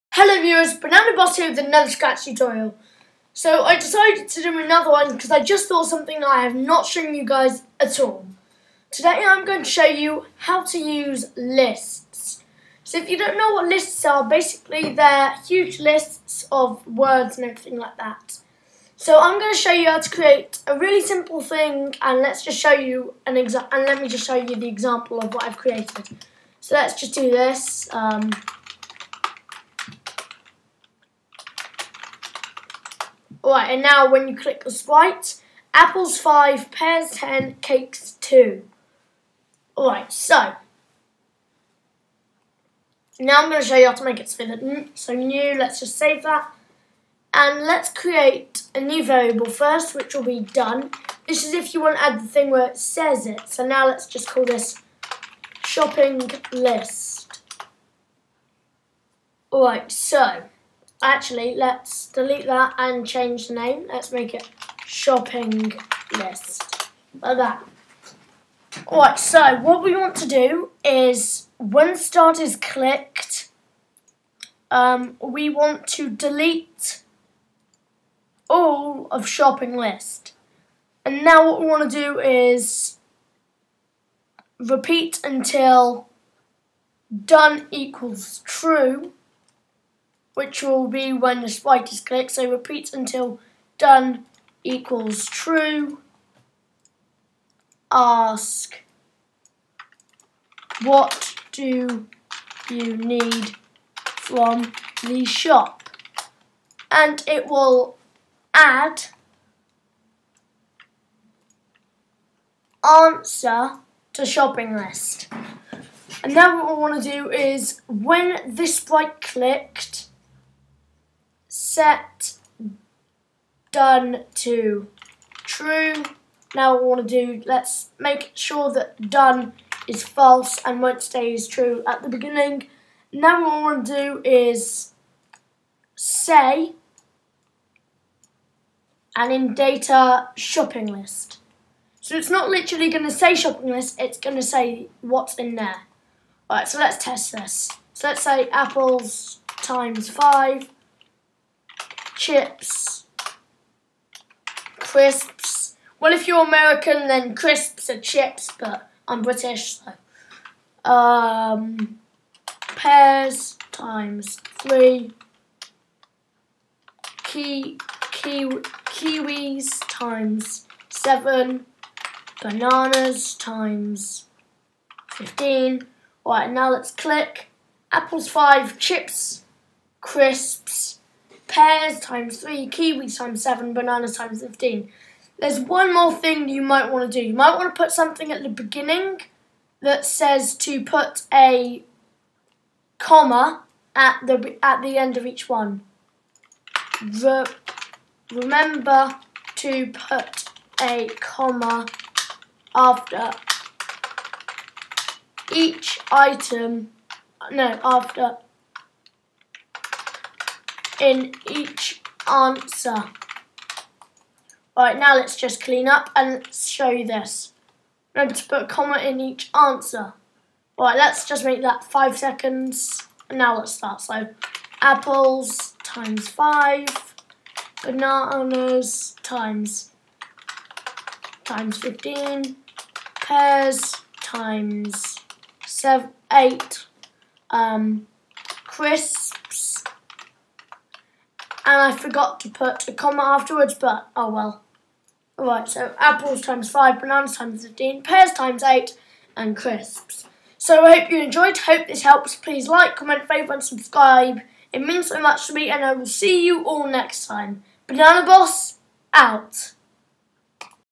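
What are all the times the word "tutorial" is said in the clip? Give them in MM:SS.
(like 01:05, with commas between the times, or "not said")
00:02.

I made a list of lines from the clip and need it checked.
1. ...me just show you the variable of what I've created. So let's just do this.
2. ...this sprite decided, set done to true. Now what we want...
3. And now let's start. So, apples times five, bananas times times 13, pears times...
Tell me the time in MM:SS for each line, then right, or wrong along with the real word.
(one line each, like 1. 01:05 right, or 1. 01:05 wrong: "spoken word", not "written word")
1. 00:23 wrong: "example", not "variable"
2. 01:58 wrong: "clicked", not "decided"
3. 03:43 wrong: "15", not "13".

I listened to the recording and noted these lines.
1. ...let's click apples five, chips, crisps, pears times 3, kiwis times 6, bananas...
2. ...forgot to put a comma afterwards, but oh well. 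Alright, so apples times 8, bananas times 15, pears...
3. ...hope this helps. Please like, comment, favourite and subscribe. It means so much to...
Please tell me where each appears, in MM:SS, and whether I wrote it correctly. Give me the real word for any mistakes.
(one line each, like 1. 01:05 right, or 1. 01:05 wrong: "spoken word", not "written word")
1. 02:56 wrong: "7", not "6"
2. 04:01 wrong: "5", not "8"
3. 04:11 right.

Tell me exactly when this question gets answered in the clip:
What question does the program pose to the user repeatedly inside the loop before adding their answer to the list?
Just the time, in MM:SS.
01:40.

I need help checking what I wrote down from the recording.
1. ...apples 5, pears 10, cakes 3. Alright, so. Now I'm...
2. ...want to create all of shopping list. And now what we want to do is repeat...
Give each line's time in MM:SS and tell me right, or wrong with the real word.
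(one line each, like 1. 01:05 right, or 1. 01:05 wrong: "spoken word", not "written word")
1. 00:35 wrong: "2", not "3"
2. 01:15 wrong: "delete", not "create".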